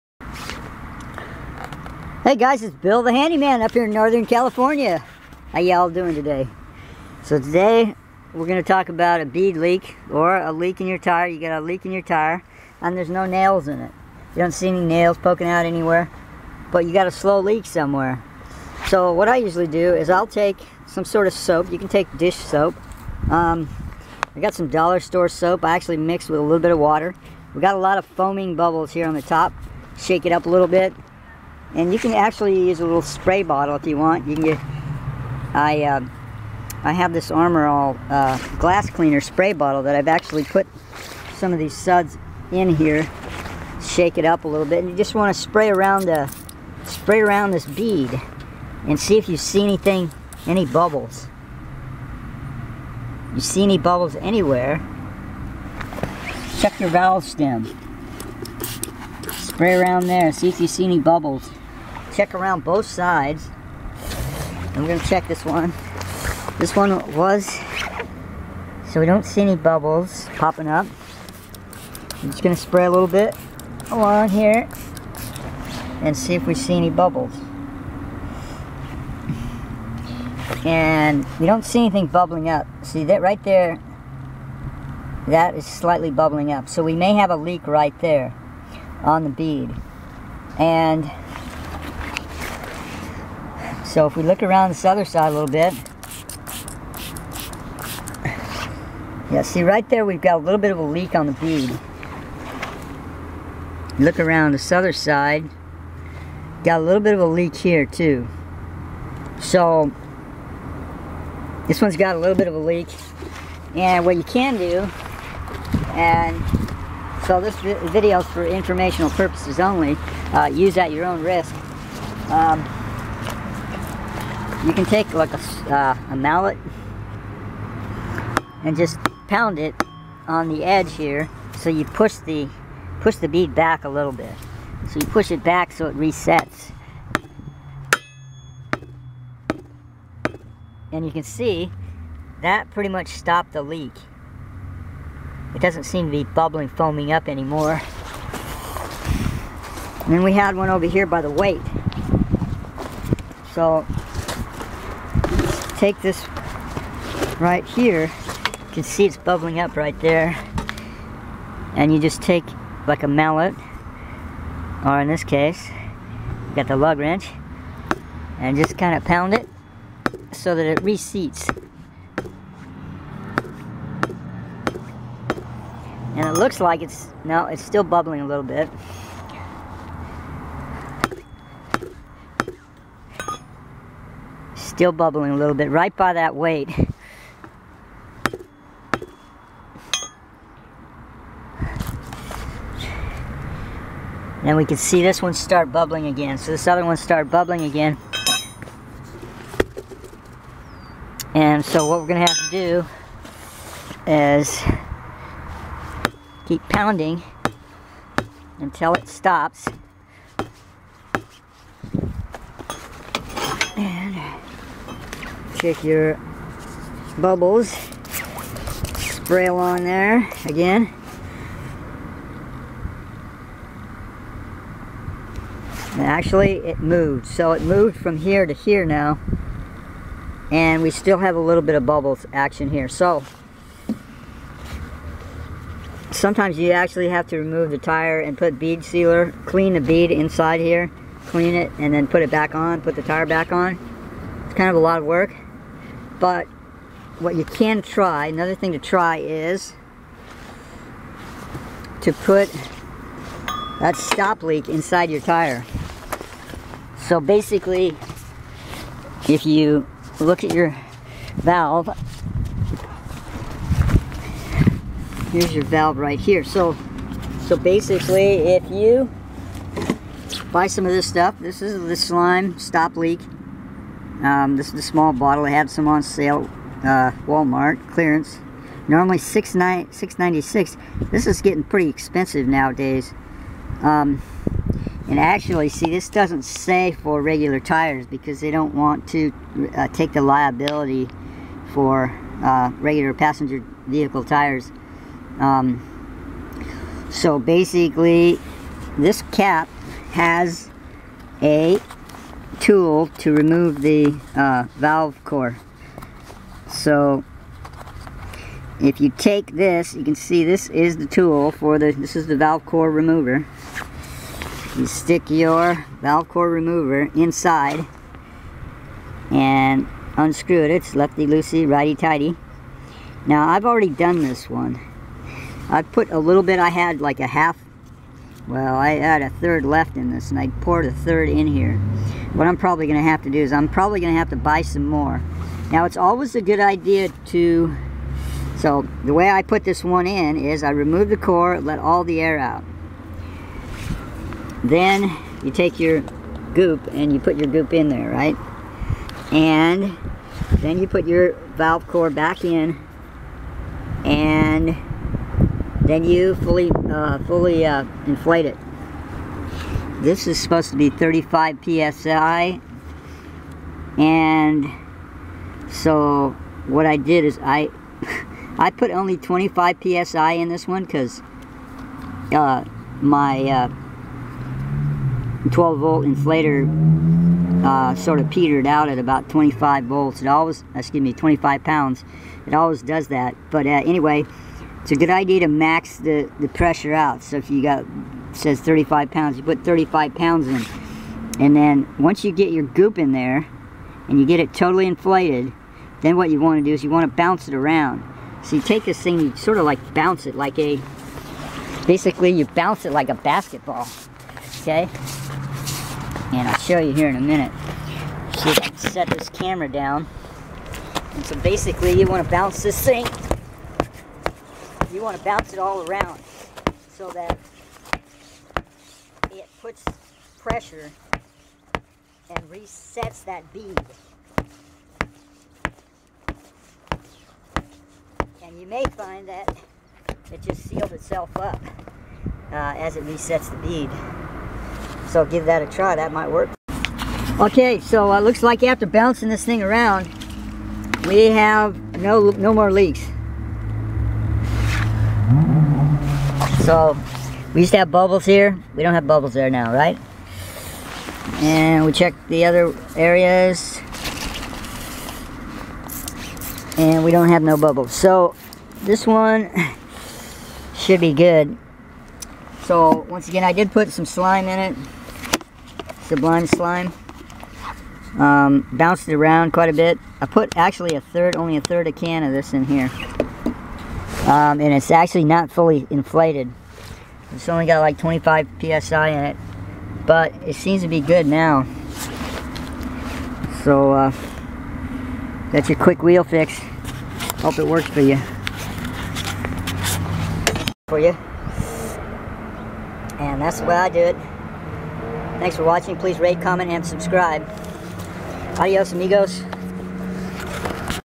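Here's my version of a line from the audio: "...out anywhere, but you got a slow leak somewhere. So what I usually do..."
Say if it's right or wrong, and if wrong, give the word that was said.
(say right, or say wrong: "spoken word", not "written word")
right.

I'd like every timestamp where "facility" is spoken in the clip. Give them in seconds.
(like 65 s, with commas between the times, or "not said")
not said.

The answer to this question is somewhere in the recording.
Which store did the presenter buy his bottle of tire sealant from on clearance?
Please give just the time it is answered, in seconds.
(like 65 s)
277 s.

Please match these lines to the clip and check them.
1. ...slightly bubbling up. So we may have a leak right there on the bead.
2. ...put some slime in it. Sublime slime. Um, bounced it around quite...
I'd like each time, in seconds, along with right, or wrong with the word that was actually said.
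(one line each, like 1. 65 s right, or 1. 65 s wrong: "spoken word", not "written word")
1. 85 s right
2. 463 s right.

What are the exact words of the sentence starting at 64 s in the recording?
I'm going to check this one.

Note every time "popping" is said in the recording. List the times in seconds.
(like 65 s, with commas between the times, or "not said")
70 s.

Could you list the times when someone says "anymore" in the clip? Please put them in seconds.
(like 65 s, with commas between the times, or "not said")
147 s.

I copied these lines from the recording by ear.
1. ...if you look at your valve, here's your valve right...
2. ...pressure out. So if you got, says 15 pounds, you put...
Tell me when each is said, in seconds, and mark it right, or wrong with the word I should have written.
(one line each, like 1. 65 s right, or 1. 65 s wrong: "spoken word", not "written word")
1. 259 s right
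2. 386 s wrong: "35", not "15".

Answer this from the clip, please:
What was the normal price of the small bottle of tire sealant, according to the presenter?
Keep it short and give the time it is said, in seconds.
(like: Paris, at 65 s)
$6.96, at 279 s.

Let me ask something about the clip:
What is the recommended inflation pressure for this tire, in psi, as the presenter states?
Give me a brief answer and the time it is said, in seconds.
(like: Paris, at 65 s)
35 psi, at 360 s.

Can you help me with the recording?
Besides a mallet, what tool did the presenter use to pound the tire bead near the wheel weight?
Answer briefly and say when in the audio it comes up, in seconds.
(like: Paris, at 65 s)
lug wrench, at 166 s.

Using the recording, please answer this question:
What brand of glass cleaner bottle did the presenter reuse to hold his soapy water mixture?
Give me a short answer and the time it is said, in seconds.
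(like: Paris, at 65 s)
Armor All, at 37 s.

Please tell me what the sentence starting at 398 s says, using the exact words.
So you take this thing, you sort of like bounce it like a, basically you bounce it like a basketball, okay?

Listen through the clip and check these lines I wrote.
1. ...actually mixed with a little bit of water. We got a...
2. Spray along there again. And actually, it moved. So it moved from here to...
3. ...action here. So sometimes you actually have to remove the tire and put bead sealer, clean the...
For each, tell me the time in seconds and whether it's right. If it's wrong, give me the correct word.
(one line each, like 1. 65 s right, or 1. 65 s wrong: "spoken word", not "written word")
1. 25 s right
2. 218 s right
3. 232 s right.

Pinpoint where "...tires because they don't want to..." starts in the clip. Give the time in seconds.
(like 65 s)
287 s.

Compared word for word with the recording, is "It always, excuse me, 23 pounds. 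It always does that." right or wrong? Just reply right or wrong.
wrong.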